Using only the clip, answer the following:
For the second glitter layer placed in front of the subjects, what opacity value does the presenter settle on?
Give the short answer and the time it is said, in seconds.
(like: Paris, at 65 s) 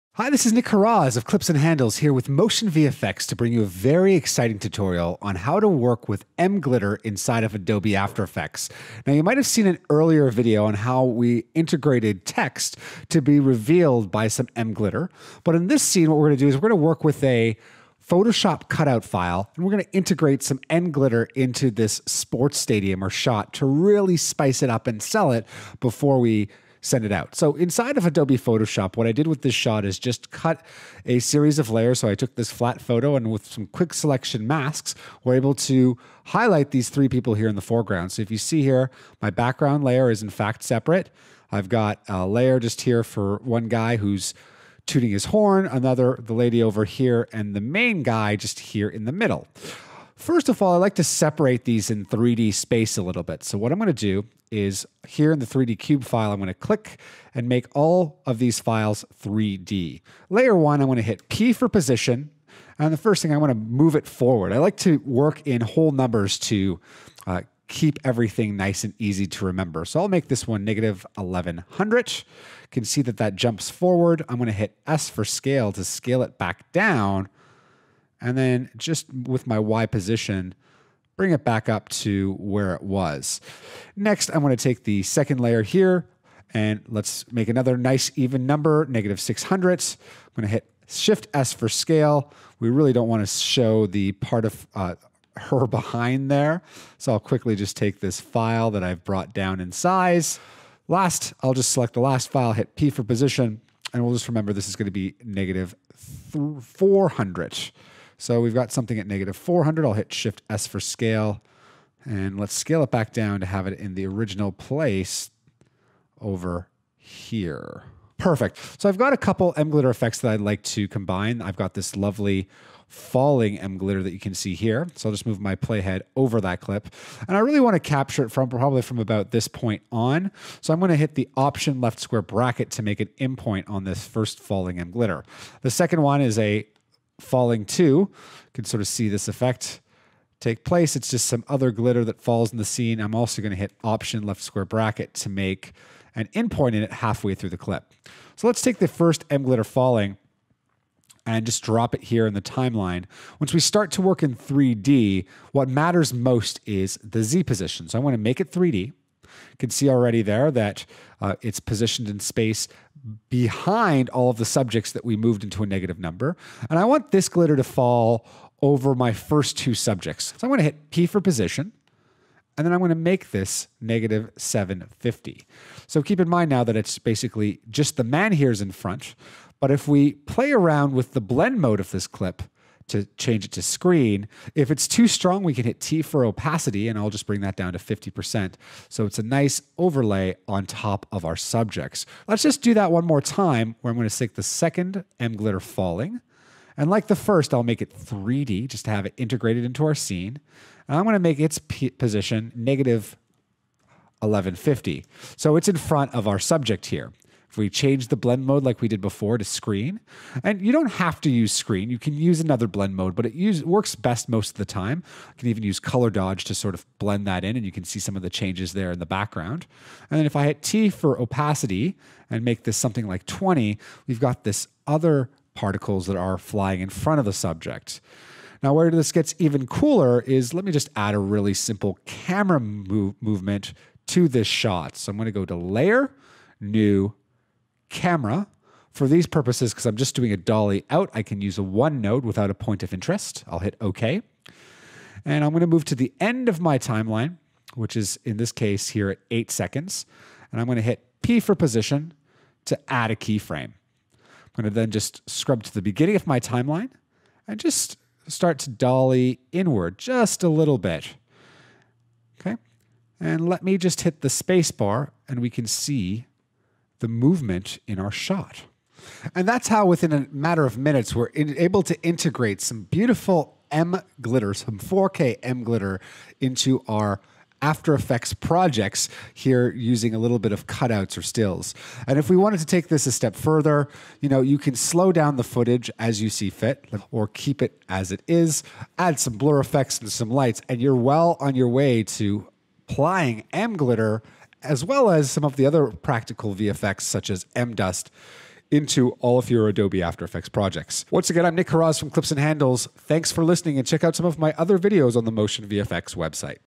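20, at 223 s.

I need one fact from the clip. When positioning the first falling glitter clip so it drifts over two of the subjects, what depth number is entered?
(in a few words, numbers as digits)
-750.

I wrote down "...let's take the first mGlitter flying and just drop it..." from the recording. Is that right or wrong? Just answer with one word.
wrong.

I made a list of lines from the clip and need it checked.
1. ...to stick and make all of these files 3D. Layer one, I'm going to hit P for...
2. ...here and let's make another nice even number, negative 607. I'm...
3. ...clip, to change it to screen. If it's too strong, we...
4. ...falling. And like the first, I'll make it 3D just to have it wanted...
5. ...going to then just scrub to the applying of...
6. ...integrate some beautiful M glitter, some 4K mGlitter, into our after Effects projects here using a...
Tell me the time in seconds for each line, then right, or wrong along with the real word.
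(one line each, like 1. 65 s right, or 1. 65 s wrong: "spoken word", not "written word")
1. 56 s wrong: "click", not "stick"
2. 85 s wrong: "600", not "607"
3. 182 s right
4. 195 s wrong: "integrated", not "wanted"
5. 254 s wrong: "beginning", not "applying"
6. 272 s right.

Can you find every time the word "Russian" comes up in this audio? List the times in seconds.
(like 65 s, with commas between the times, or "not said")
not said.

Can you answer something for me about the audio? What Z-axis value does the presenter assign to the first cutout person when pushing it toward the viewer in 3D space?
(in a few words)
-1100.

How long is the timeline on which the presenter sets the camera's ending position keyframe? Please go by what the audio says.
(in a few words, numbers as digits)
8 seconds.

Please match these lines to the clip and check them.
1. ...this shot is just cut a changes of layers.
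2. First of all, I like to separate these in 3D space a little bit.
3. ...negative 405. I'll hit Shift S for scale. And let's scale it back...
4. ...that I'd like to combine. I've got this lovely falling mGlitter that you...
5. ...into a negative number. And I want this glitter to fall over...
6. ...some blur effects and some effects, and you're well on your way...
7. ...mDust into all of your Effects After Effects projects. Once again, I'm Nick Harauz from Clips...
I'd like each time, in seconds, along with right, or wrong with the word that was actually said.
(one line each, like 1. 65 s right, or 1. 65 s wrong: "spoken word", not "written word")
1. 29 s wrong: "series", not "changes"
2. 50 s right
3. 109 s wrong: "400", not "405"
4. 120 s right
5. 165 s right
6. 289 s wrong: "lights", not "effects"
7. 297 s wrong: "Adobe", not "Effects".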